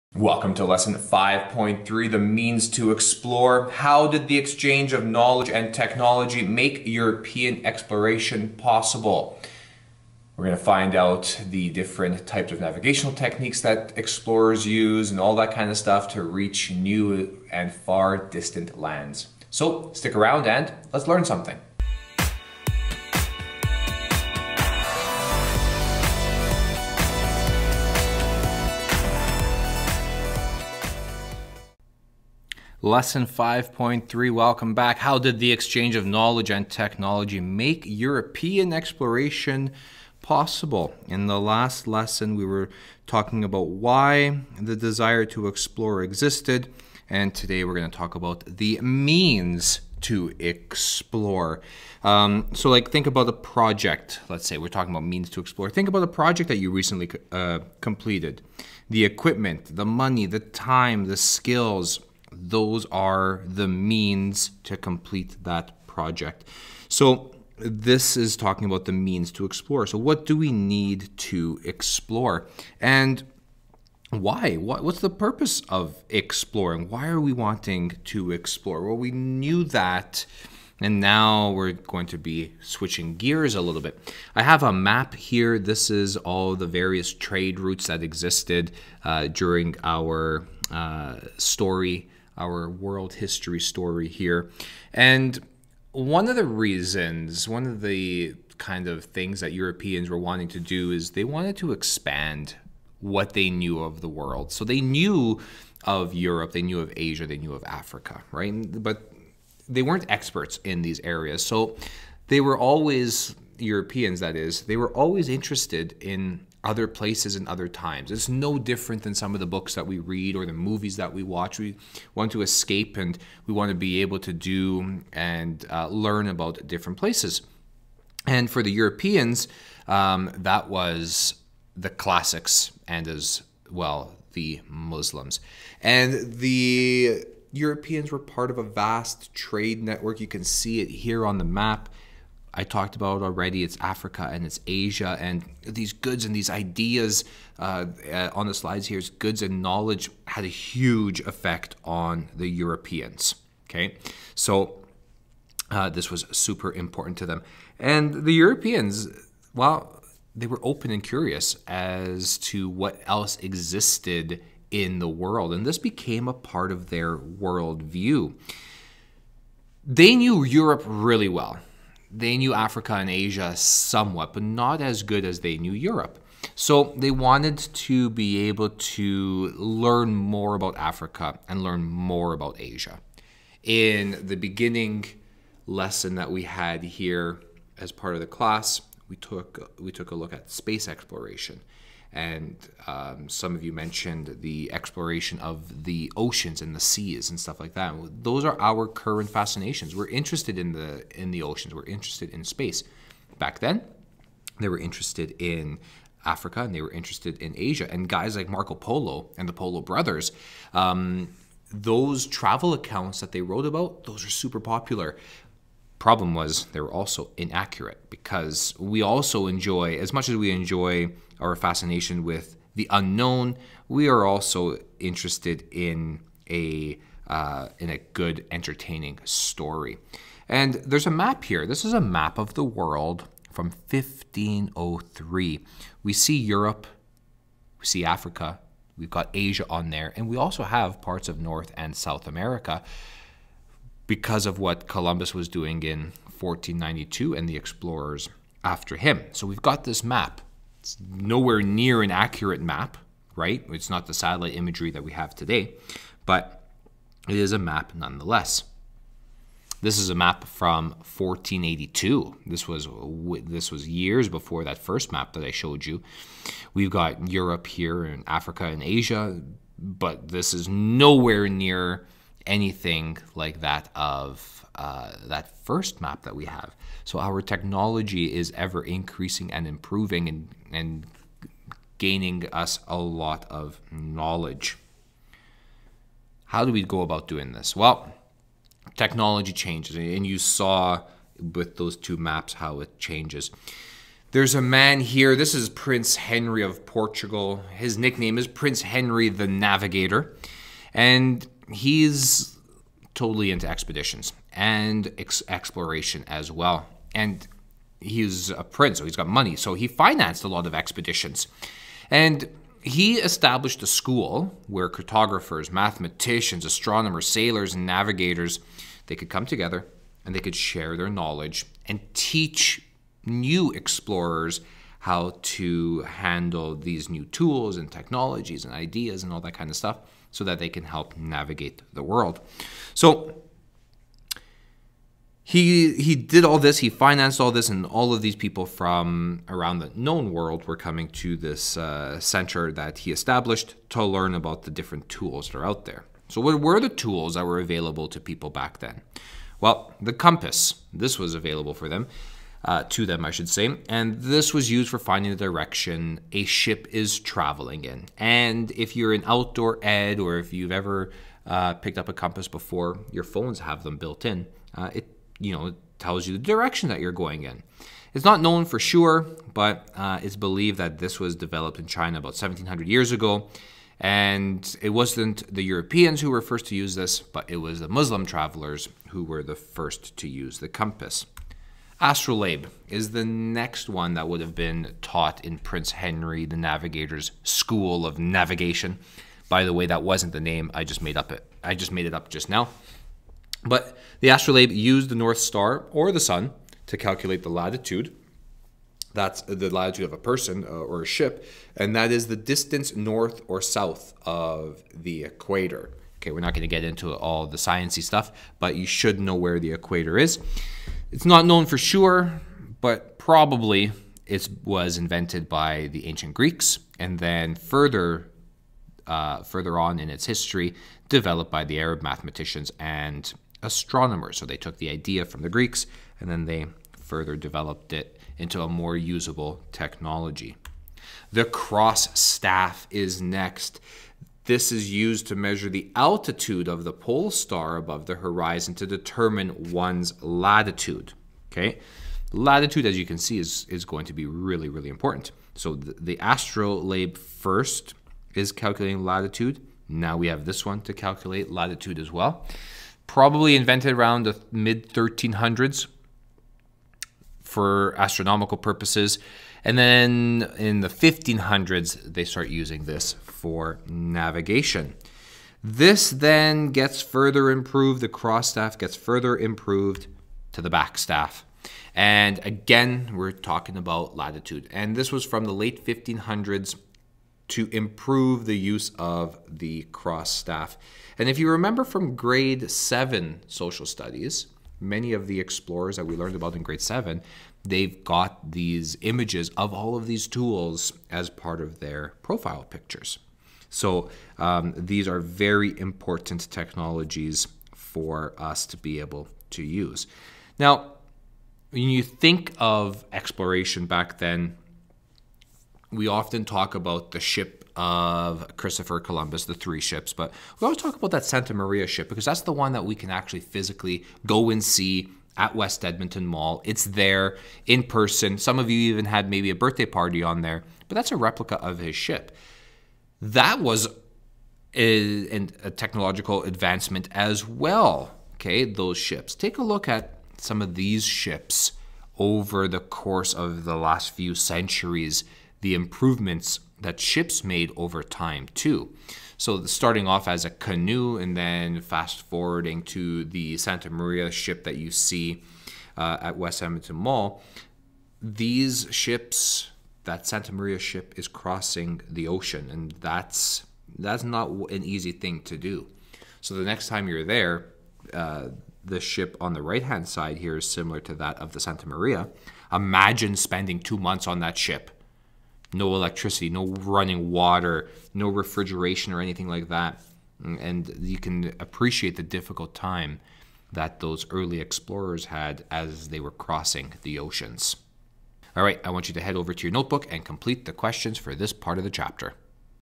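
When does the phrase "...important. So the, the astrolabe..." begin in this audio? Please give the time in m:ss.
7:24.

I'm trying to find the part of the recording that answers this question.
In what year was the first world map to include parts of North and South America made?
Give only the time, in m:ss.
3:53.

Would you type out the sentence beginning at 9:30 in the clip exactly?
And you can appreciate the difficult time that those early explorers had as they were crossing the oceans.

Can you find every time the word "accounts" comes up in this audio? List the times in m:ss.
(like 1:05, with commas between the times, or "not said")
3:32.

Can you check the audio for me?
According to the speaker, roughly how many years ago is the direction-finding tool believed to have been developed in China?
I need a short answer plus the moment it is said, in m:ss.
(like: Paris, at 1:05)
1700 years ago, at 6:12.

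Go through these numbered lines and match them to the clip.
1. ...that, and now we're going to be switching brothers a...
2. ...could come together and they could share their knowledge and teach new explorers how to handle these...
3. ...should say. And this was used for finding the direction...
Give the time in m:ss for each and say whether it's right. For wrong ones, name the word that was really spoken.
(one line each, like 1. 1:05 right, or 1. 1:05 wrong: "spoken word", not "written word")
1. 1:19 wrong: "gears", not "brothers"
2. 5:19 right
3. 5:53 right.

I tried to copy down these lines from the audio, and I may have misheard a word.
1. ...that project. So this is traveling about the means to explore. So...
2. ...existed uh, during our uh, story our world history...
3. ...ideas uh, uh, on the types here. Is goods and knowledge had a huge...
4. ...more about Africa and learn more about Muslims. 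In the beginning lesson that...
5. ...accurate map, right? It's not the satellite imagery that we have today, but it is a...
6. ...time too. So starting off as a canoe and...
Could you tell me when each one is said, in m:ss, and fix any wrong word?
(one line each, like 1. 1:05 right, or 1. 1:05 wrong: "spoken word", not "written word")
1. 1:05 wrong: "talking", not "traveling"
2. 1:28 right
3. 2:26 wrong: "slides", not "types"
4. 3:00 wrong: "Asia", not "Muslims"
5. 4:12 right
6. 8:58 right.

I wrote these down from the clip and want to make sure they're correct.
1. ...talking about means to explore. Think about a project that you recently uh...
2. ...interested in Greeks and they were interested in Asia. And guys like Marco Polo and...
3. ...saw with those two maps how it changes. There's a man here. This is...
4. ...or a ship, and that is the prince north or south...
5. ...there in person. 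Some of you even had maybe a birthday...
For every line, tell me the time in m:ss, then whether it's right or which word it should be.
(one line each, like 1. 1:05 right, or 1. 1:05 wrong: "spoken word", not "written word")
1. 0:54 right
2. 3:24 wrong: "Africa", not "Greeks"
3. 4:50 right
4. 6:40 wrong: "distance", not "prince"
5. 8:36 right.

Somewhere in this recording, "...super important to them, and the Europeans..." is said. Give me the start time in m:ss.
2:36.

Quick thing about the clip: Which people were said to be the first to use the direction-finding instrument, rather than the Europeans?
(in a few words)
Muslim travelers.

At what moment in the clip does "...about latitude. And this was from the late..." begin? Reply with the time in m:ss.
7:53.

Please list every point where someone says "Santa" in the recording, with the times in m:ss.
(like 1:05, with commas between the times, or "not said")
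8:31, 9:03, 9:10, 9:21.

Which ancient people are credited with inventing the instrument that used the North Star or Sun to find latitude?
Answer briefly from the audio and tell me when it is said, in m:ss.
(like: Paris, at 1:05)
ancient Greeks, at 6:56.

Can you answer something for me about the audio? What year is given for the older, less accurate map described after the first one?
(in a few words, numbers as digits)
1482.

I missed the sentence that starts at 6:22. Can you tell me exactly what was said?
Astrolabe is the next one that would have been taught in Prince Henry the Navigator's School of Navigation.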